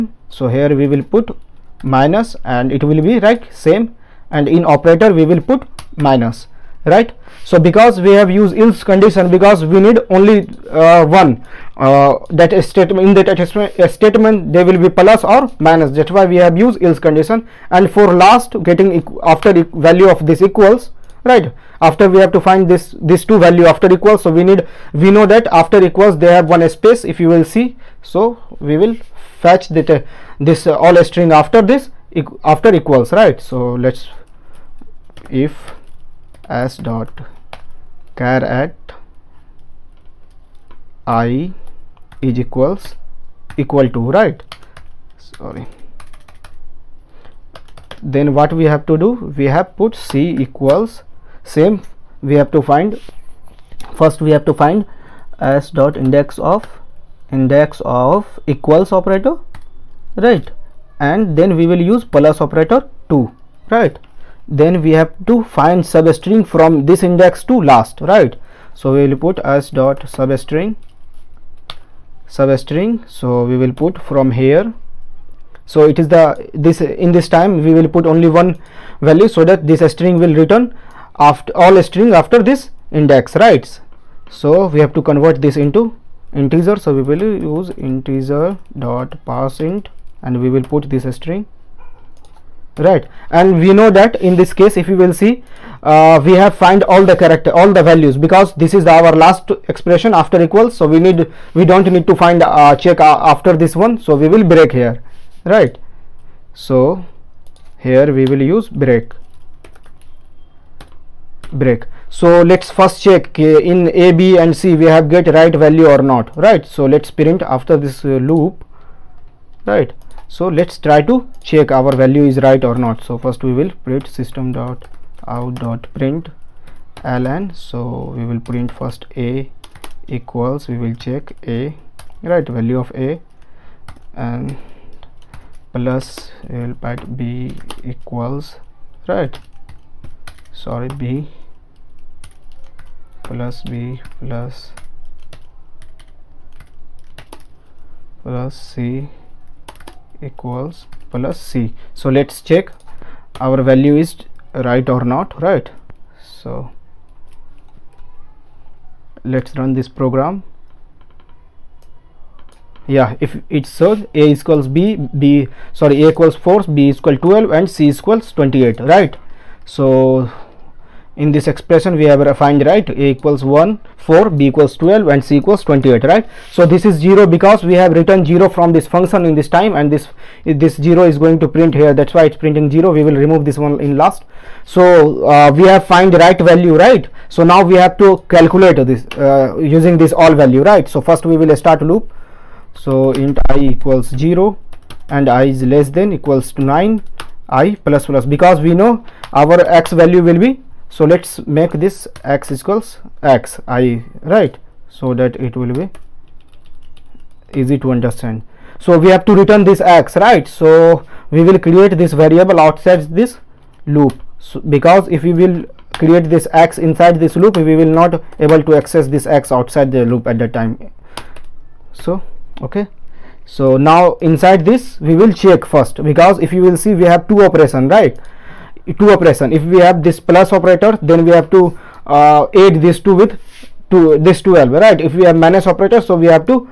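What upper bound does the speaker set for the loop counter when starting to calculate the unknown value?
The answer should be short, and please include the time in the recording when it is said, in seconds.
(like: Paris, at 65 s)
9, at 196 s.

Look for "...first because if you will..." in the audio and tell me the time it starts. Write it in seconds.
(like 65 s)
225 s.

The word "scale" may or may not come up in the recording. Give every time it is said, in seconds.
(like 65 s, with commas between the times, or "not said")
not said.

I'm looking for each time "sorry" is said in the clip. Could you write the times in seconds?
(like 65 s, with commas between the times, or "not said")
45 s, 140 s, 165 s.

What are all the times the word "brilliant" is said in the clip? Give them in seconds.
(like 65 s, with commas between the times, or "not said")
not said.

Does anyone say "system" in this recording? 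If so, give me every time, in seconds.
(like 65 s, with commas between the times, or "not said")
124 s.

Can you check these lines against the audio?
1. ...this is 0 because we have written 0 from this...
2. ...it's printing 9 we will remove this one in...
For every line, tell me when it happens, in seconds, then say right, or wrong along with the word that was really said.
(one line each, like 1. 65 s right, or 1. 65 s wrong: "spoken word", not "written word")
1. 176 s right
2. 182 s wrong: "0", not "9".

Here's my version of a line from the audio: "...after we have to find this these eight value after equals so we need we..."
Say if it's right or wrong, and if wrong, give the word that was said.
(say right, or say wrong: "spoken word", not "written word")
wrong: "two", not "eight".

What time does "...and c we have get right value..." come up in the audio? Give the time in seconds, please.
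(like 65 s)
114 s.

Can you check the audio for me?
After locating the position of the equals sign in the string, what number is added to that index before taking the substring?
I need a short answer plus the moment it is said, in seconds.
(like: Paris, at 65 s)
2, at 63 s.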